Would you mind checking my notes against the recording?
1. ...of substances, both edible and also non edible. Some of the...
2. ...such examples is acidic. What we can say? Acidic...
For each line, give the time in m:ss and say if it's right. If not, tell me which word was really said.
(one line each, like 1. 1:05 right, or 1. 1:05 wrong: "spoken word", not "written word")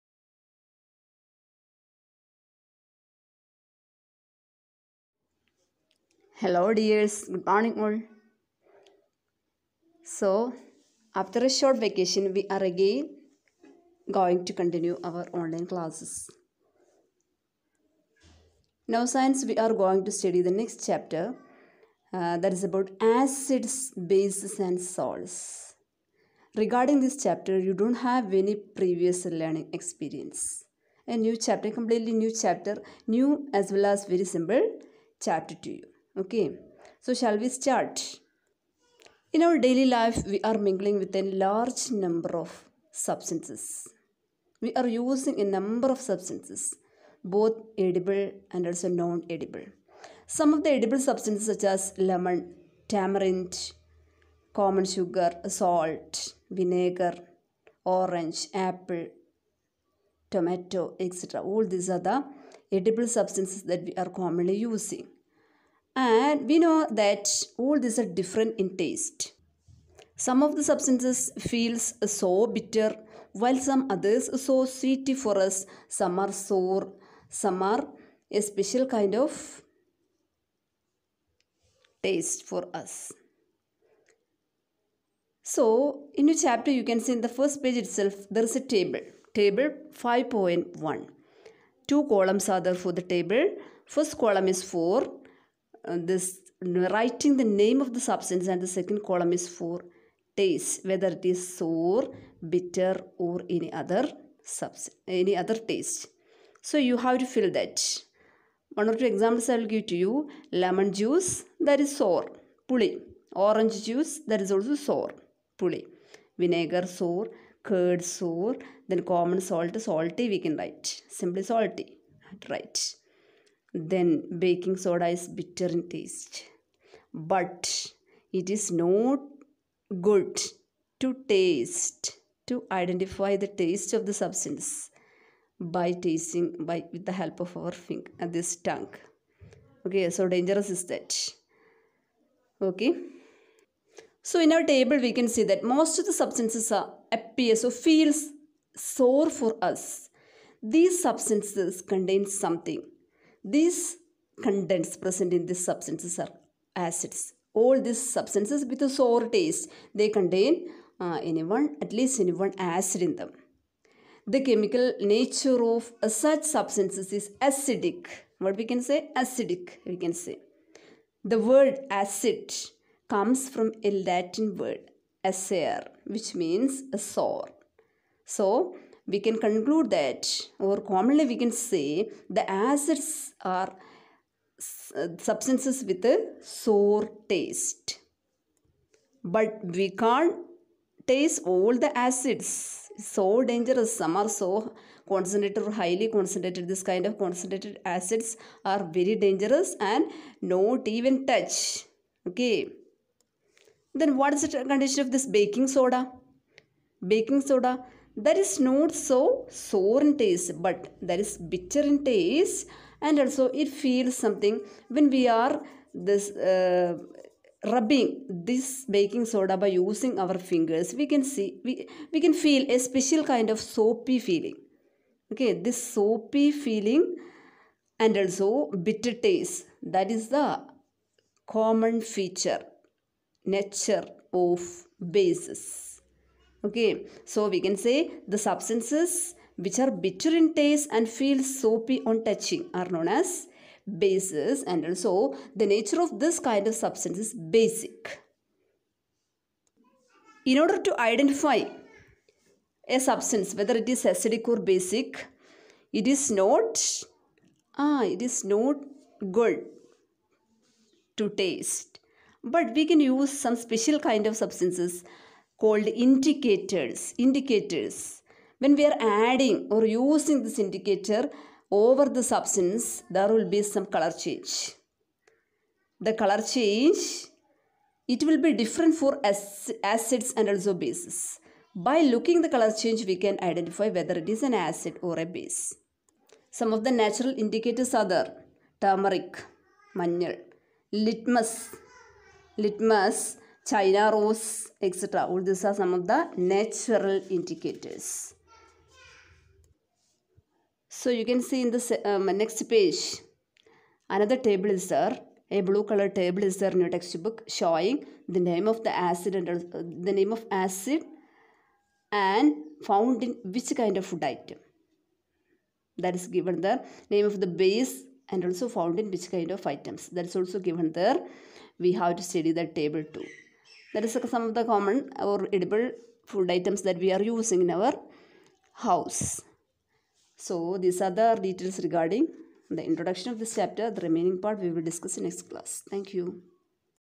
1. 0:45 right
2. 2:46 wrong: "substances", not "examples".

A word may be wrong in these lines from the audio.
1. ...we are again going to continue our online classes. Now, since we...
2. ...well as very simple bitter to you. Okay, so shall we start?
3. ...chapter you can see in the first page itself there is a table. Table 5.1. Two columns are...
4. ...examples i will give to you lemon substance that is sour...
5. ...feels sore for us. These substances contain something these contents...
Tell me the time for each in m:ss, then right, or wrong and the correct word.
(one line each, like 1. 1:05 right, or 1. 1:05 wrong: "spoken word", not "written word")
1. 0:12 right
2. 0:33 wrong: "chapter", not "bitter"
3. 1:26 right
4. 1:49 wrong: "juice", not "substance"
5. 2:27 right.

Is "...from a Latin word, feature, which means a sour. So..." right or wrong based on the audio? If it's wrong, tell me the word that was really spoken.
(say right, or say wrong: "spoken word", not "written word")
wrong: "acere", not "feature".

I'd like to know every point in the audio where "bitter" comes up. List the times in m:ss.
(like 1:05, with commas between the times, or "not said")
1:12, 1:42, 2:05, 3:31, 3:48, 4:00.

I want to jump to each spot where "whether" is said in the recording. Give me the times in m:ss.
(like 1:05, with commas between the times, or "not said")
1:40, 4:13, 4:43.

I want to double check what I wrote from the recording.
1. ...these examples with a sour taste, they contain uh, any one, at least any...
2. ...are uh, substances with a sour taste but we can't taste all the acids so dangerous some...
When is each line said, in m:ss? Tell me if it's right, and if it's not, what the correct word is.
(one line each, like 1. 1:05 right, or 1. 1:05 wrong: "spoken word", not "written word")
1. 2:37 wrong: "substances", not "examples"
2. 3:03 right.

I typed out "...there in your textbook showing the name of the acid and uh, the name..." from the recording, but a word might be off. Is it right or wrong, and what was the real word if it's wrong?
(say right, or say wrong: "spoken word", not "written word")
right.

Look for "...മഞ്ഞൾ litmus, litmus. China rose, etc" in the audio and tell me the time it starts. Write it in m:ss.
4:49.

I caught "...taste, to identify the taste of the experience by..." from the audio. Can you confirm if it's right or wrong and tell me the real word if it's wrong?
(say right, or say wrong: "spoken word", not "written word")
wrong: "substance", not "experience".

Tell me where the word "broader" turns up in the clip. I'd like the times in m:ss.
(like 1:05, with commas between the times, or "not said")
not said.